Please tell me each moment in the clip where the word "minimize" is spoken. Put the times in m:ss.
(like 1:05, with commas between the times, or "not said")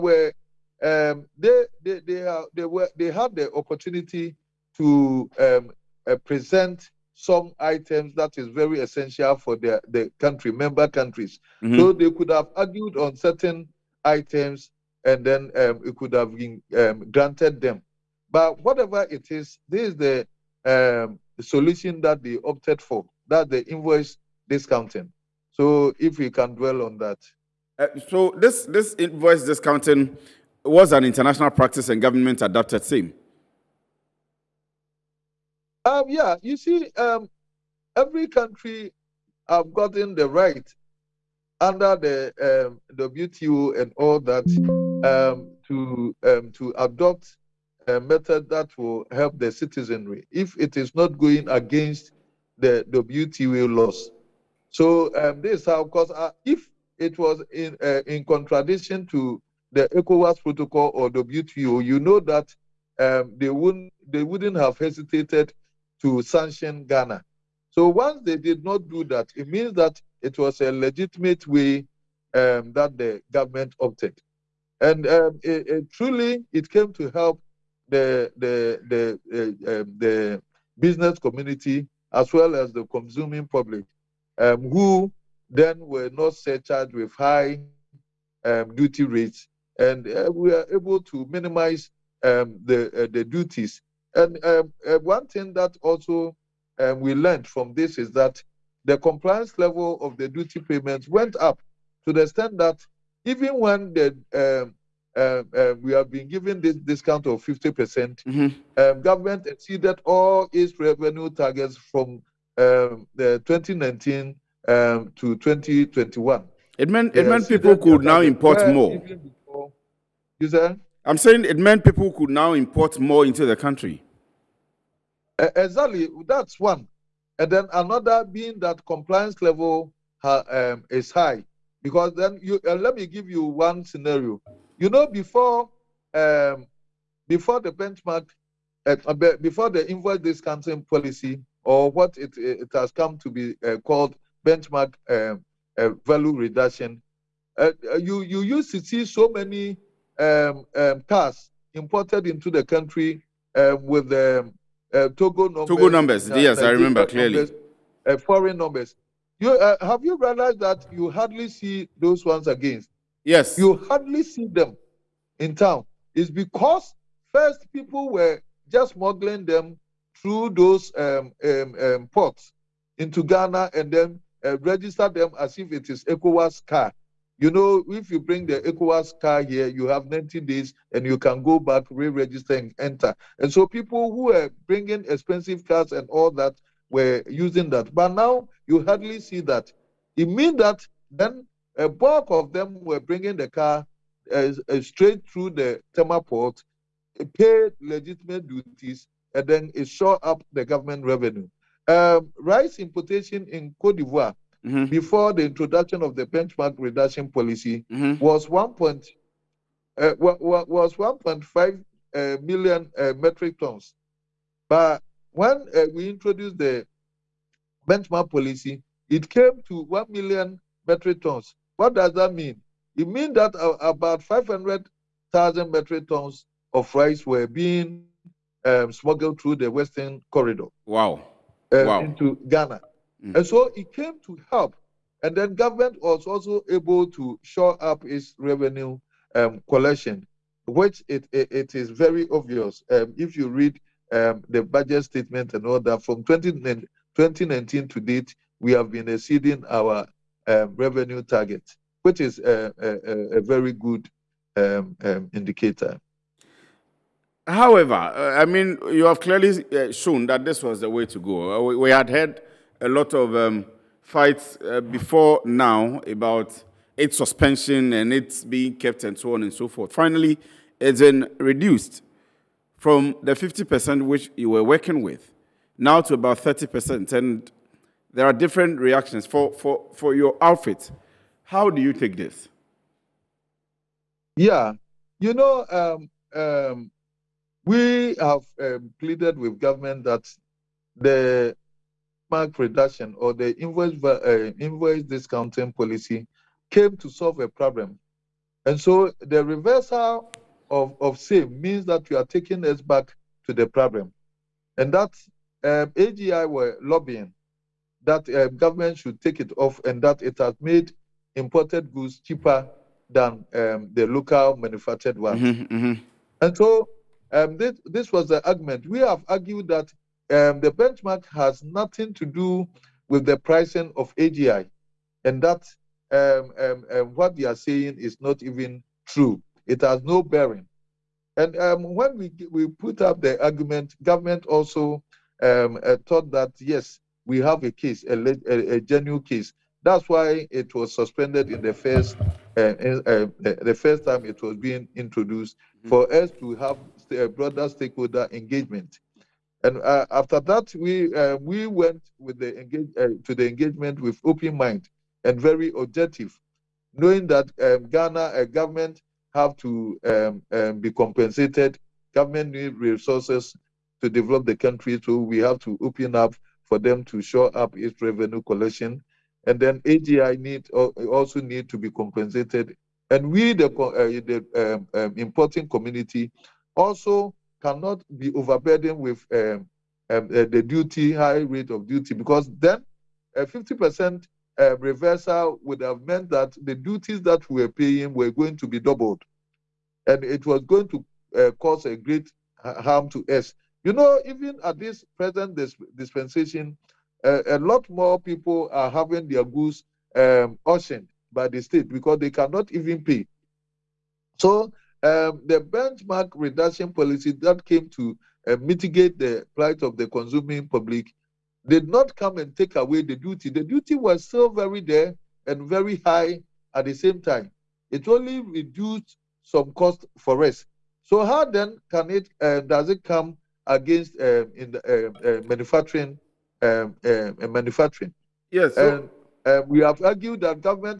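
1:31.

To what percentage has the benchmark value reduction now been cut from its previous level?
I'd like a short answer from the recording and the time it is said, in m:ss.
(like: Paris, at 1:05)
30%, at 4:36.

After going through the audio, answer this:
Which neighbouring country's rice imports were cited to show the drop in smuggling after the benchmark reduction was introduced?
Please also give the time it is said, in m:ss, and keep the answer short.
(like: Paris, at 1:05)
Cote d'Ivoire, at 3:23.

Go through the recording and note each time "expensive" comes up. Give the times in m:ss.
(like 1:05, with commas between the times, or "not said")
3:05.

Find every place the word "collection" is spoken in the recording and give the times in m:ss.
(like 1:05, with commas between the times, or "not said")
3:59, 6:08.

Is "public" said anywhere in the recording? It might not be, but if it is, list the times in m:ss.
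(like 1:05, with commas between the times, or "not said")
1:23, 6:50.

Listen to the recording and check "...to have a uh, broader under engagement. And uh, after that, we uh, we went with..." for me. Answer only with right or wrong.
wrong.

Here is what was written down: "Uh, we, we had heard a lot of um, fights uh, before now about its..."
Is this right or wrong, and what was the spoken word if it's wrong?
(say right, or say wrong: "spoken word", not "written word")
right.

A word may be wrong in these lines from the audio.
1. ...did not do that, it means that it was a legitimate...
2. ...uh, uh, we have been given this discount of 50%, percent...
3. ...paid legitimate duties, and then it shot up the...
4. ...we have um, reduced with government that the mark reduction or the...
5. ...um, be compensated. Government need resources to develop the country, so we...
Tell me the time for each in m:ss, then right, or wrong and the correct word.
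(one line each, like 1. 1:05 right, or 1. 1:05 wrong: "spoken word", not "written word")
1. 1:08 right
2. 1:45 right
3. 3:17 right
4. 4:47 wrong: "pleaded", not "reduced"
5. 6:00 right.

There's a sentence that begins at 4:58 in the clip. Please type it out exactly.
And so the reversal of, of same means that we are taking us back to the problem.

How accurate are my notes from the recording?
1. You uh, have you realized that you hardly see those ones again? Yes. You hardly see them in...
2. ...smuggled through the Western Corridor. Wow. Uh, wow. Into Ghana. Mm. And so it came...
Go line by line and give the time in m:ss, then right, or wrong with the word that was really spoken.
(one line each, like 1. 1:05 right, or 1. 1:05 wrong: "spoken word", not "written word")
1. 2:39 right
2. 3:48 right.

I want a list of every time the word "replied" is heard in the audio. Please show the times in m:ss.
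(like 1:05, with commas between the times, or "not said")
not said.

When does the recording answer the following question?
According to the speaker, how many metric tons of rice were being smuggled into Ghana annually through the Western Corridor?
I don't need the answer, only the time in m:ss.
3:44.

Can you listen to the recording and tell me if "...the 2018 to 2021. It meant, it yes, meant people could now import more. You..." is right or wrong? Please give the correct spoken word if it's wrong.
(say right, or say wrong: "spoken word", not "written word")
wrong: "2019", not "2018".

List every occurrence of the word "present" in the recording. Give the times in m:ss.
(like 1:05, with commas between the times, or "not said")
0:06, 6:35.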